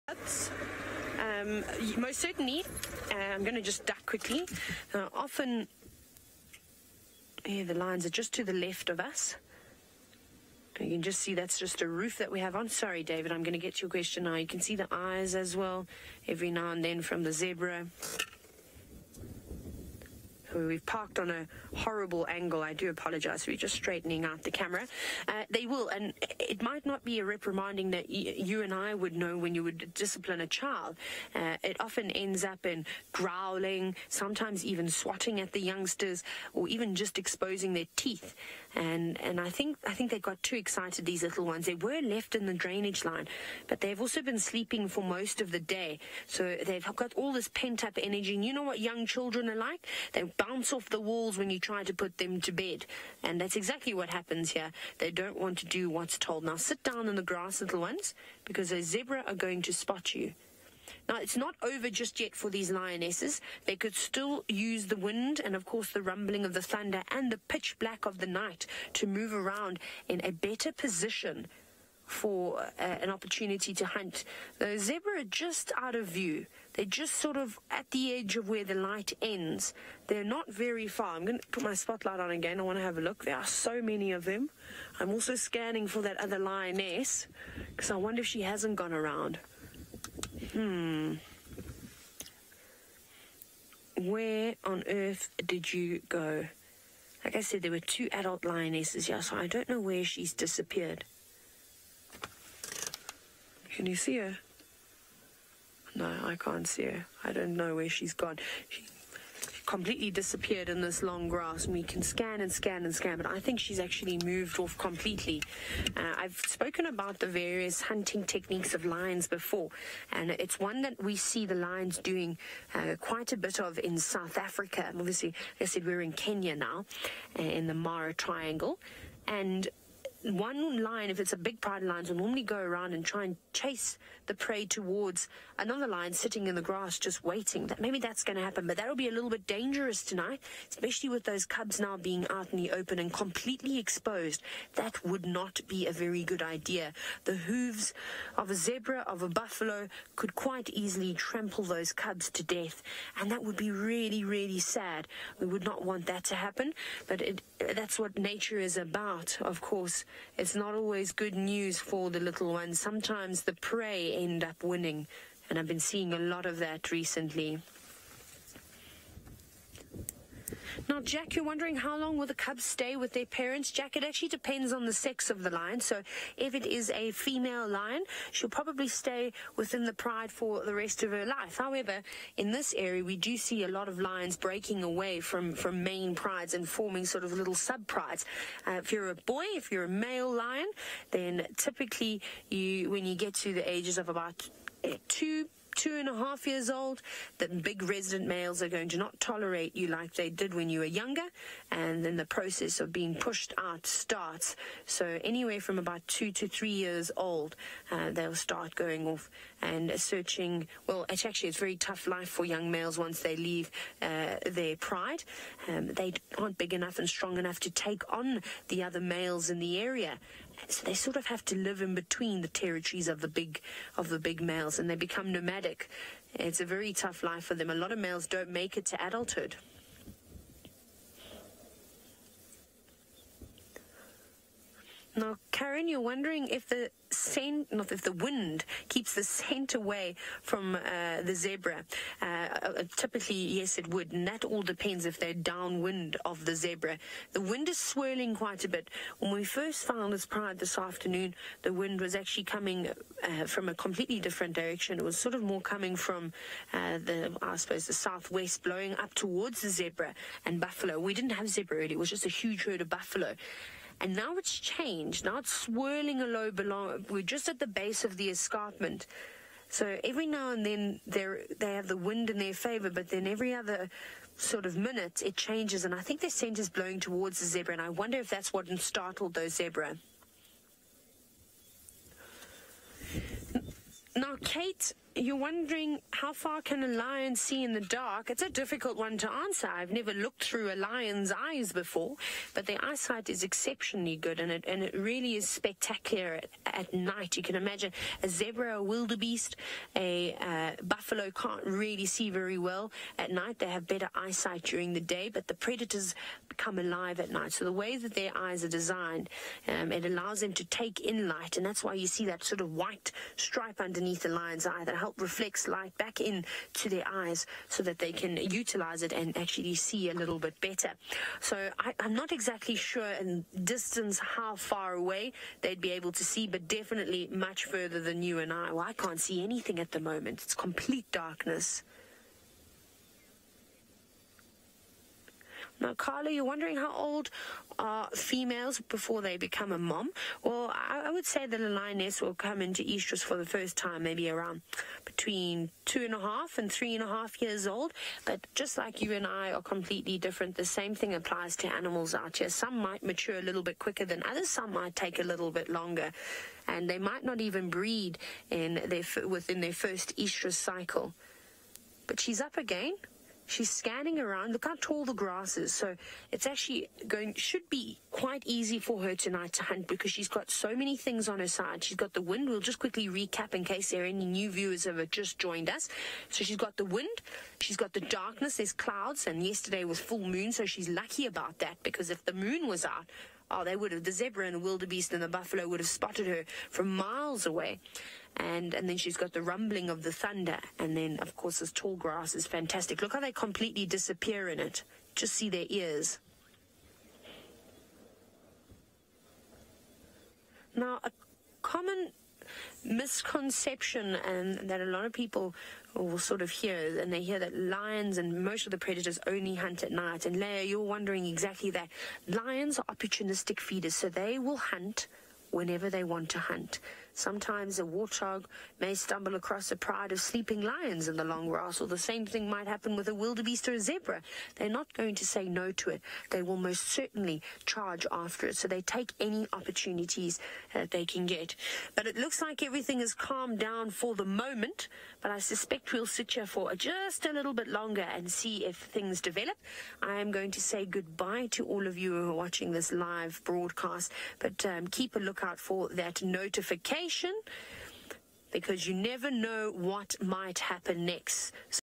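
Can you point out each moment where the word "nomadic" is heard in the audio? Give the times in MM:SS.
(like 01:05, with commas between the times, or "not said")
03:45.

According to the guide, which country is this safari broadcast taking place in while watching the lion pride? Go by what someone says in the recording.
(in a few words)
Kenya.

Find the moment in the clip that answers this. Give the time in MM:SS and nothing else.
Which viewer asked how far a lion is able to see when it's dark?
04:44.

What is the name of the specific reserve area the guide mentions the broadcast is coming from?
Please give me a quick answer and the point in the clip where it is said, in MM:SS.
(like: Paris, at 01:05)
Mara Triangle, at 02:07.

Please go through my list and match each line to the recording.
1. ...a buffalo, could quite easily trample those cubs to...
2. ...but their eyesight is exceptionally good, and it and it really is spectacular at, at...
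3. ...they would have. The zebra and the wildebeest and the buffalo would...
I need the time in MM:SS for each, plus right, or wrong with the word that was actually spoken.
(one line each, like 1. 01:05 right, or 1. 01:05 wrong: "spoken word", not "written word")
1. 02:29 right
2. 04:52 right
3. 06:23 right.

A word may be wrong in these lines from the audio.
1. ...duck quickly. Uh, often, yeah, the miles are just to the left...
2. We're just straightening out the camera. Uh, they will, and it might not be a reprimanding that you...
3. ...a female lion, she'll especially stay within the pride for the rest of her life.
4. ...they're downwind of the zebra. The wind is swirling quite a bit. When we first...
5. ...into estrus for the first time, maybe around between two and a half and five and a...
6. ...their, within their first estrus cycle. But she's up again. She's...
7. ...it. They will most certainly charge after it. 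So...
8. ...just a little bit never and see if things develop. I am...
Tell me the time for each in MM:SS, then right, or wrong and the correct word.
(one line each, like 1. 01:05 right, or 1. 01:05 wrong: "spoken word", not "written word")
1. 00:03 wrong: "lines", not "miles"
2. 00:23 right
3. 02:56 wrong: "probably", not "especially"
4. 04:05 right
5. 05:42 wrong: "three", not "five"
6. 05:58 right
7. 07:05 right
8. 07:16 wrong: "longer", not "never".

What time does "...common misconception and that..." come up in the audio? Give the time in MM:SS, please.
06:41.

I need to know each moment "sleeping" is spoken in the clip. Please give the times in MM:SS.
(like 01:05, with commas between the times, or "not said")
00:44, 07:00.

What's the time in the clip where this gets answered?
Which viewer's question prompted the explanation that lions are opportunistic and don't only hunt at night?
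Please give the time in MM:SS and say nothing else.
06:50.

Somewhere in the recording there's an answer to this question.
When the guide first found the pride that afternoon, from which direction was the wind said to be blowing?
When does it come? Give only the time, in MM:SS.
04:17.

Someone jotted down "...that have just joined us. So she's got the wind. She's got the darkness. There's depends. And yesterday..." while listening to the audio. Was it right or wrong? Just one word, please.
wrong.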